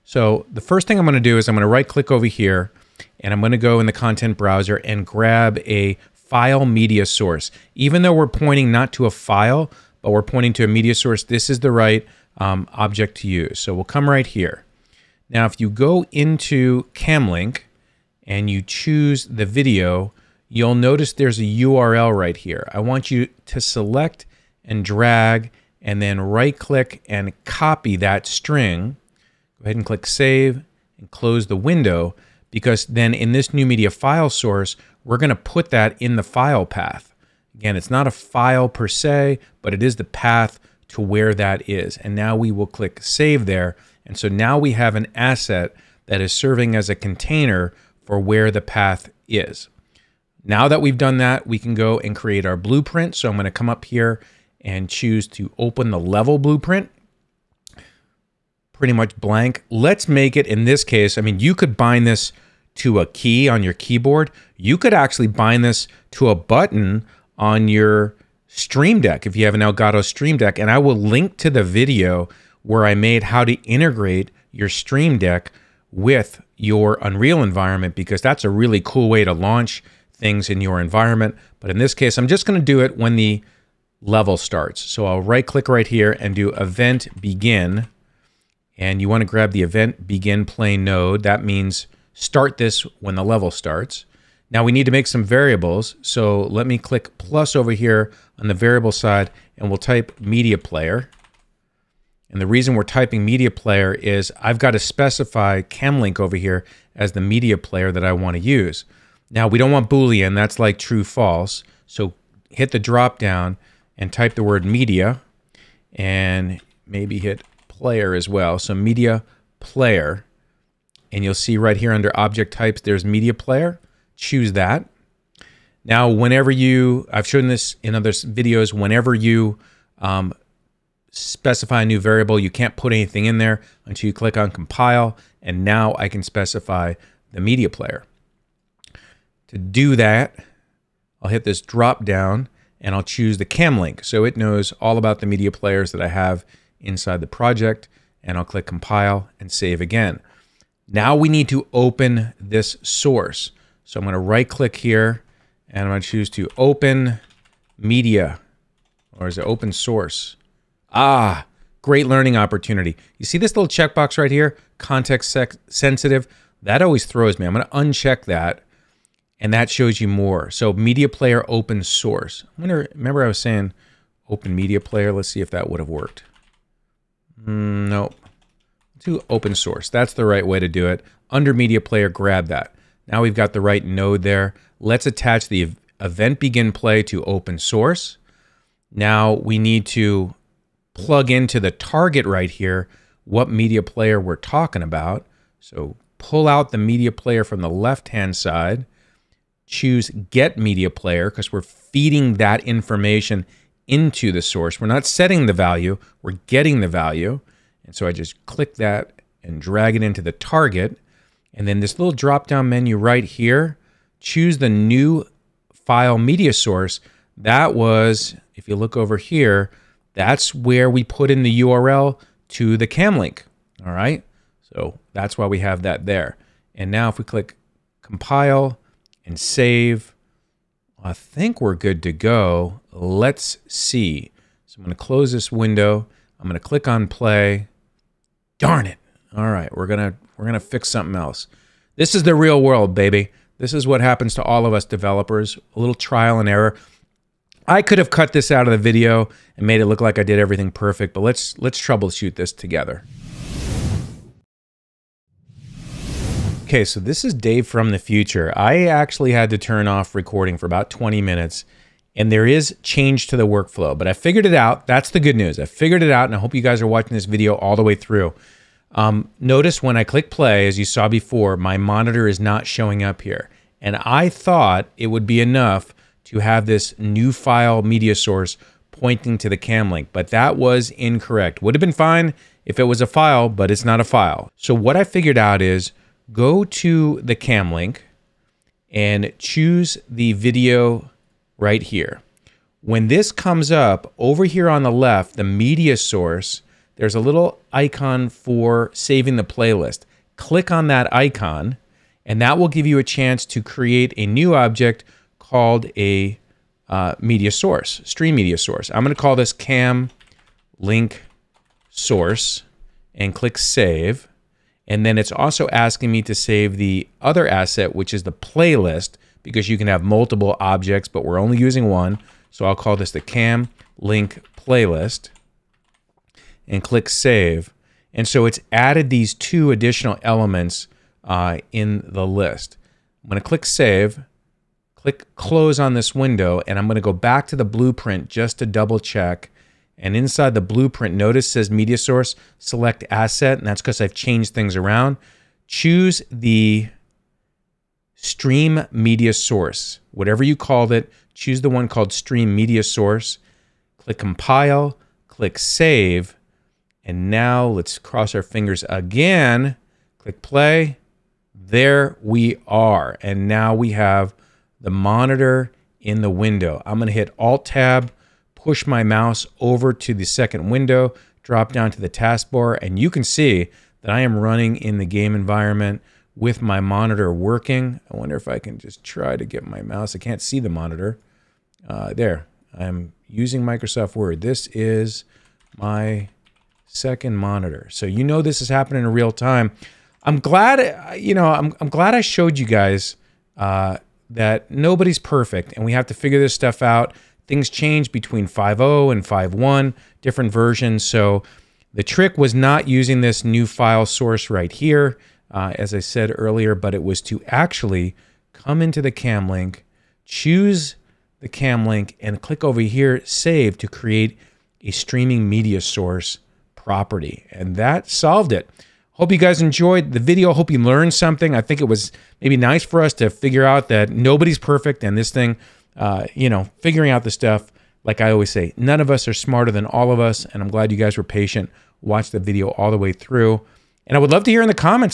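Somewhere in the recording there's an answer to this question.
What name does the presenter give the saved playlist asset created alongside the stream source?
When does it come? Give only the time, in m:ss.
5:23.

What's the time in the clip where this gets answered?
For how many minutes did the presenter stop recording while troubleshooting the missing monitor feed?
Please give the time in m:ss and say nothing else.
4:20.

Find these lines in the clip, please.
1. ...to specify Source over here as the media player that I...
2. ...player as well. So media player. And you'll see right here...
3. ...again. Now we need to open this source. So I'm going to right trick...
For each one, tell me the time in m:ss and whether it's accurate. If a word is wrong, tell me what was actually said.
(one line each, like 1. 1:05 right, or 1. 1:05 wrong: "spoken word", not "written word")
1. 1:44 wrong: "Camlink", not "Source"
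2. 1:57 right
3. 2:29 wrong: "click", not "trick".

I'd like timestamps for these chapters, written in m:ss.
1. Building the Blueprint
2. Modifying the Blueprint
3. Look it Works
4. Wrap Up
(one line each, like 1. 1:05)
1. 0:50
2. 4:15
3. 5:58
4. 6:58.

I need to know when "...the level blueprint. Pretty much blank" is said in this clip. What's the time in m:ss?
0:55.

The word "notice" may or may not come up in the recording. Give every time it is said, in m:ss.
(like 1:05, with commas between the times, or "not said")
0:20, 4:29, 5:41.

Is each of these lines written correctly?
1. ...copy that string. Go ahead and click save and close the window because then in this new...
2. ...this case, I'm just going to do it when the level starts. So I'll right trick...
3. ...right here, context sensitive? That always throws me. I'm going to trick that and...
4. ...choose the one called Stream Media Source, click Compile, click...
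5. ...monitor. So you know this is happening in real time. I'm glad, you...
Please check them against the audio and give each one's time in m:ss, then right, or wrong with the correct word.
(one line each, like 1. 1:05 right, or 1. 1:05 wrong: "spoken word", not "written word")
1. 0:27 right
2. 1:21 wrong: "click", not "trick"
3. 2:44 wrong: "uncheck", not "trick"
4. 5:51 right
5. 6:27 right.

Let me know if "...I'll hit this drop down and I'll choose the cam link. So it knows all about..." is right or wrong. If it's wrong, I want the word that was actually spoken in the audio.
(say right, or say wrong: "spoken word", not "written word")
right.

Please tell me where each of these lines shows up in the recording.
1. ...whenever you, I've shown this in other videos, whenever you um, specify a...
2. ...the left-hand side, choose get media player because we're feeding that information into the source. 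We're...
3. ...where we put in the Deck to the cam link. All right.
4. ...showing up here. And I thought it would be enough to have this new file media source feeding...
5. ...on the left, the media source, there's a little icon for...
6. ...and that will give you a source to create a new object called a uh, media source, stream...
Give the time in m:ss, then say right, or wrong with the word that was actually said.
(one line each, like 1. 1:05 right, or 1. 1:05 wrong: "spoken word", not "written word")
1. 2:06 right
2. 3:17 right
3. 3:40 wrong: "URL", not "Deck"
4. 4:32 wrong: "pointing", not "feeding"
5. 4:54 right
6. 5:02 wrong: "chance", not "source".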